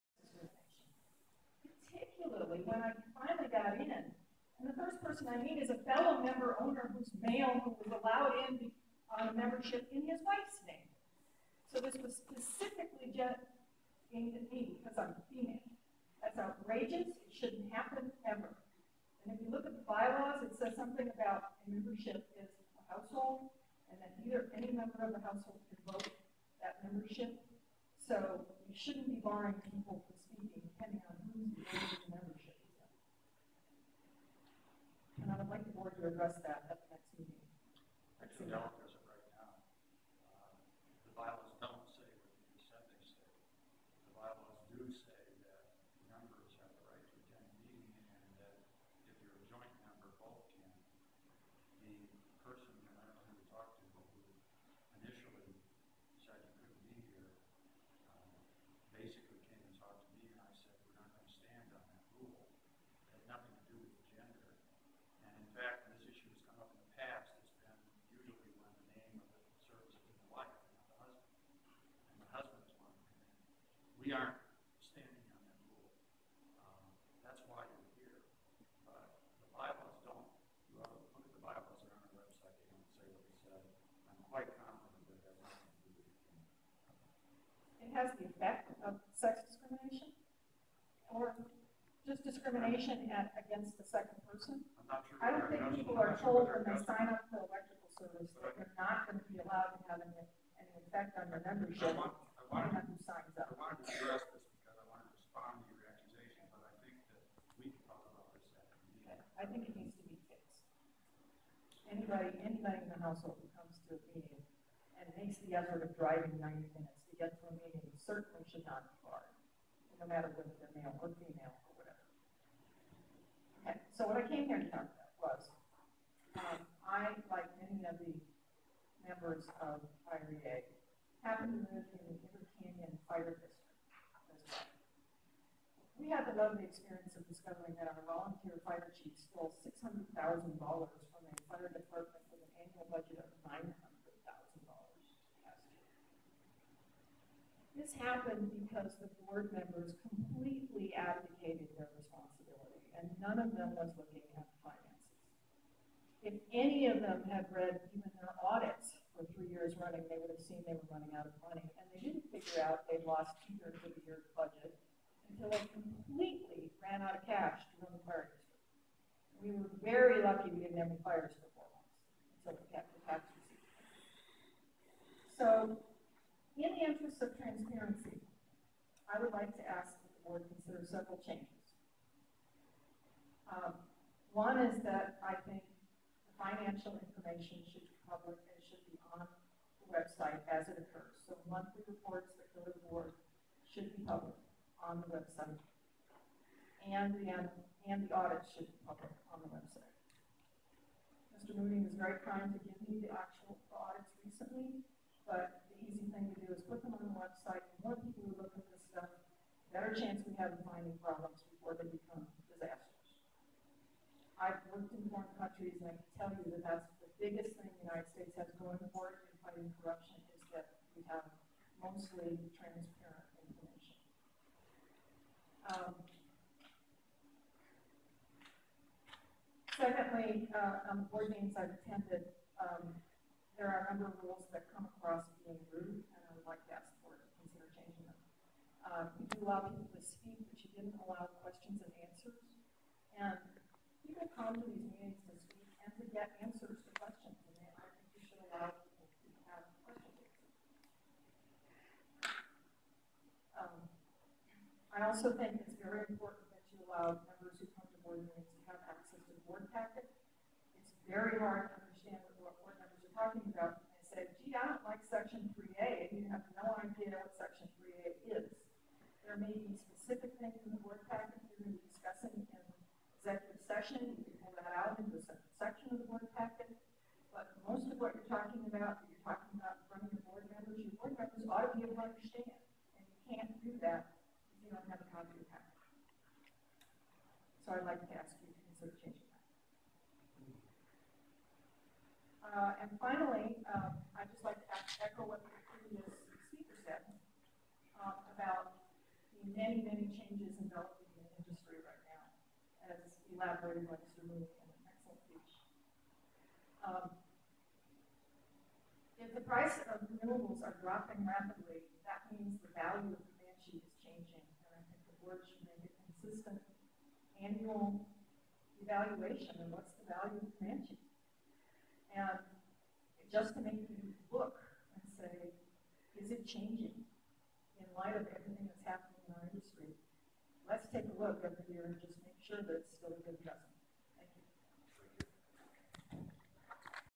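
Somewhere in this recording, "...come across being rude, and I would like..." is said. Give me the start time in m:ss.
3:54.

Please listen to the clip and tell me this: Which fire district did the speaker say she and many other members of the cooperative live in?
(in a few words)
Inner Canyon Fire District.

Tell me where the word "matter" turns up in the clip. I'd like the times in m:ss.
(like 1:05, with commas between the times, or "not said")
2:00.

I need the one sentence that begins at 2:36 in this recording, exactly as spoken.
If any of them had read even their running, they would have seen they were running out of money.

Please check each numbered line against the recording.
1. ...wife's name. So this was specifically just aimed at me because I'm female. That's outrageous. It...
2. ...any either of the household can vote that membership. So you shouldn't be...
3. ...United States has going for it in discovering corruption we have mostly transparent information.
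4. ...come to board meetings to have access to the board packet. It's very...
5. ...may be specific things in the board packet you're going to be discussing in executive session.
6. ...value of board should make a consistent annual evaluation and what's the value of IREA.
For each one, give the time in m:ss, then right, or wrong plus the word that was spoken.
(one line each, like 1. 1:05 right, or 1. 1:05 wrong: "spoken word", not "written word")
1. 0:10 right
2. 0:24 wrong: "member", not "either"
3. 3:37 wrong: "fighting", not "discovering"
4. 4:17 right
5. 4:29 right
6. 5:12 wrong: "Comanche", not "IREA".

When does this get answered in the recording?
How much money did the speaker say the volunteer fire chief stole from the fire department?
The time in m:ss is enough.
2:19.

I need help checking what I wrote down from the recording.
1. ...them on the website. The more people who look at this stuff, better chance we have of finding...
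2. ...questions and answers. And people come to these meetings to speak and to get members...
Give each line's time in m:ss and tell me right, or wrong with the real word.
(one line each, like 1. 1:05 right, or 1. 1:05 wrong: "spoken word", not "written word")
1. 3:26 right
2. 4:01 wrong: "answers", not "members".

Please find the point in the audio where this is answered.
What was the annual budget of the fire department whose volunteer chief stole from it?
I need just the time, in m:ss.
2:23.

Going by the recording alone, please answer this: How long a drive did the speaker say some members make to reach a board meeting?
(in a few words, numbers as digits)
90 minutes.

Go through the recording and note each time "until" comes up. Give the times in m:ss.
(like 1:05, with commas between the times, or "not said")
2:45, 2:52.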